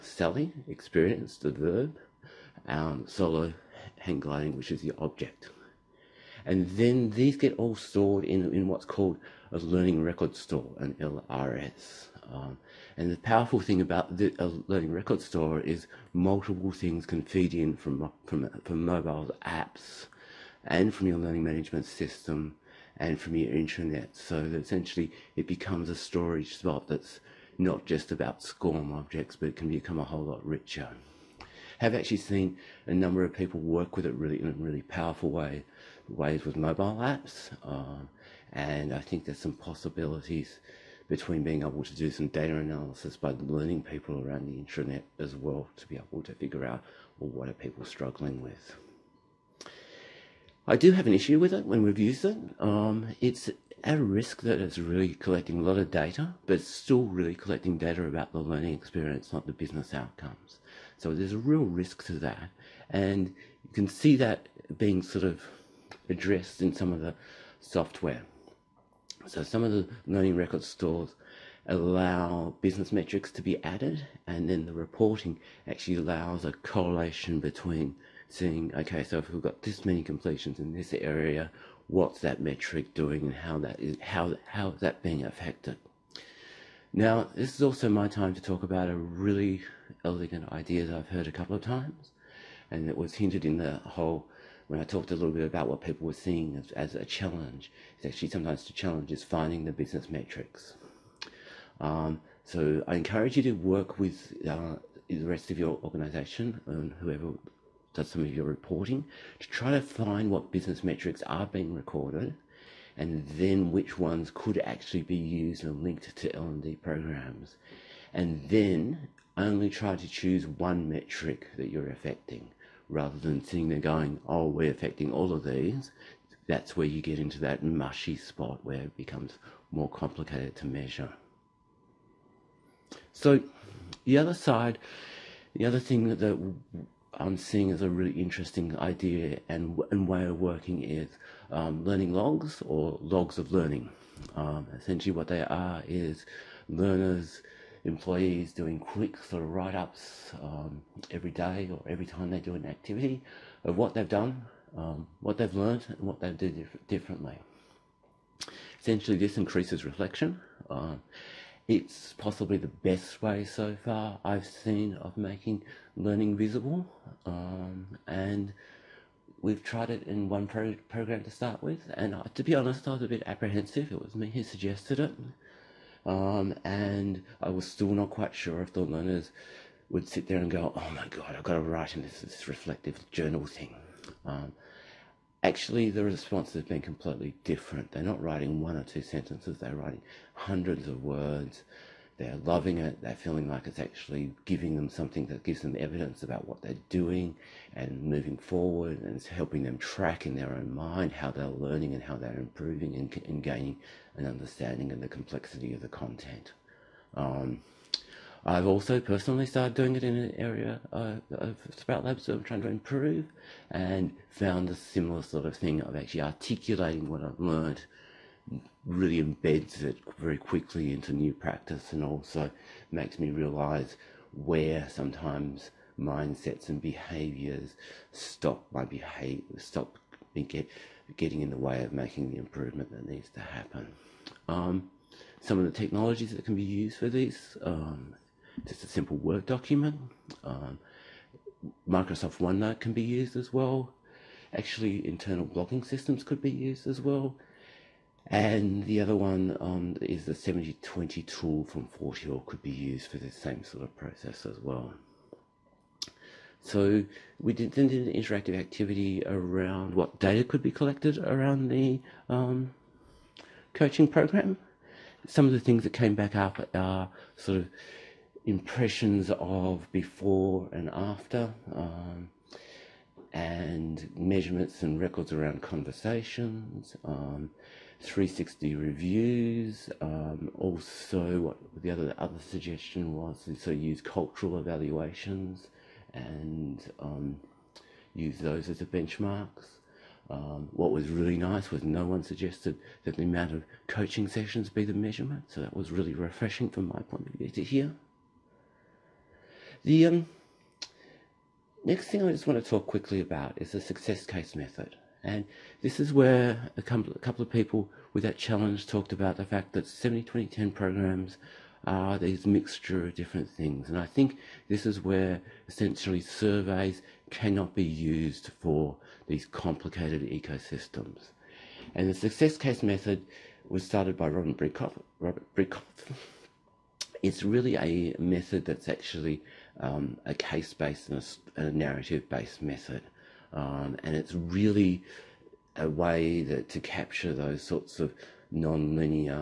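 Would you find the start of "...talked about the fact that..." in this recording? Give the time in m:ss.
5:08.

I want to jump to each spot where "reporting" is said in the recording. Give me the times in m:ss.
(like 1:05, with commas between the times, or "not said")
1:14, 1:48.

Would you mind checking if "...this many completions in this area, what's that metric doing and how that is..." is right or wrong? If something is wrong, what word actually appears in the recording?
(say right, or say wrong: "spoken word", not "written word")
right.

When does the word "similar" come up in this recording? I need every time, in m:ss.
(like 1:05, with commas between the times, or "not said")
3:34.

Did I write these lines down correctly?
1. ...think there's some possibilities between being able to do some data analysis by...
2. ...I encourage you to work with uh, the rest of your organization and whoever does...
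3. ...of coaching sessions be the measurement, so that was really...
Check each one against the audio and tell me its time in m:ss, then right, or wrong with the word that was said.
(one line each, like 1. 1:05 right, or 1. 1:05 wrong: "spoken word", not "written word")
1. 0:38 right
2. 1:42 right
3. 4:53 right.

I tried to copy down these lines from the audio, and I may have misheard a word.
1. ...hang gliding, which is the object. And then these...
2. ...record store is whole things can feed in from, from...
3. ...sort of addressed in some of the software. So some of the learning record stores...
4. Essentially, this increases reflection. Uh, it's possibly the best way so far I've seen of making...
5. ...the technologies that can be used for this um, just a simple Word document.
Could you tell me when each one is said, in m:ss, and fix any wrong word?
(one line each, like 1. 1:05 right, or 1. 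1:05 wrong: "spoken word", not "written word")
1. 0:03 right
2. 0:14 wrong: "multiple", not "whole"
3. 1:05 right
4. 2:38 right
5. 3:55 right.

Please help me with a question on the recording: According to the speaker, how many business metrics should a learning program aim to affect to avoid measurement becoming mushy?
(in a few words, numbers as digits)
1.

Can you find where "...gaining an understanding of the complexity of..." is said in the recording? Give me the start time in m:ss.
3:23.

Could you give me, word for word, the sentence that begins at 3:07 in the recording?
They're not writing one or two sentences, they're writing hundreds of words.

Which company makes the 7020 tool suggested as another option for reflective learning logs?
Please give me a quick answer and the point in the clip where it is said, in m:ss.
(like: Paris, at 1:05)
Fort Hill, at 4:11.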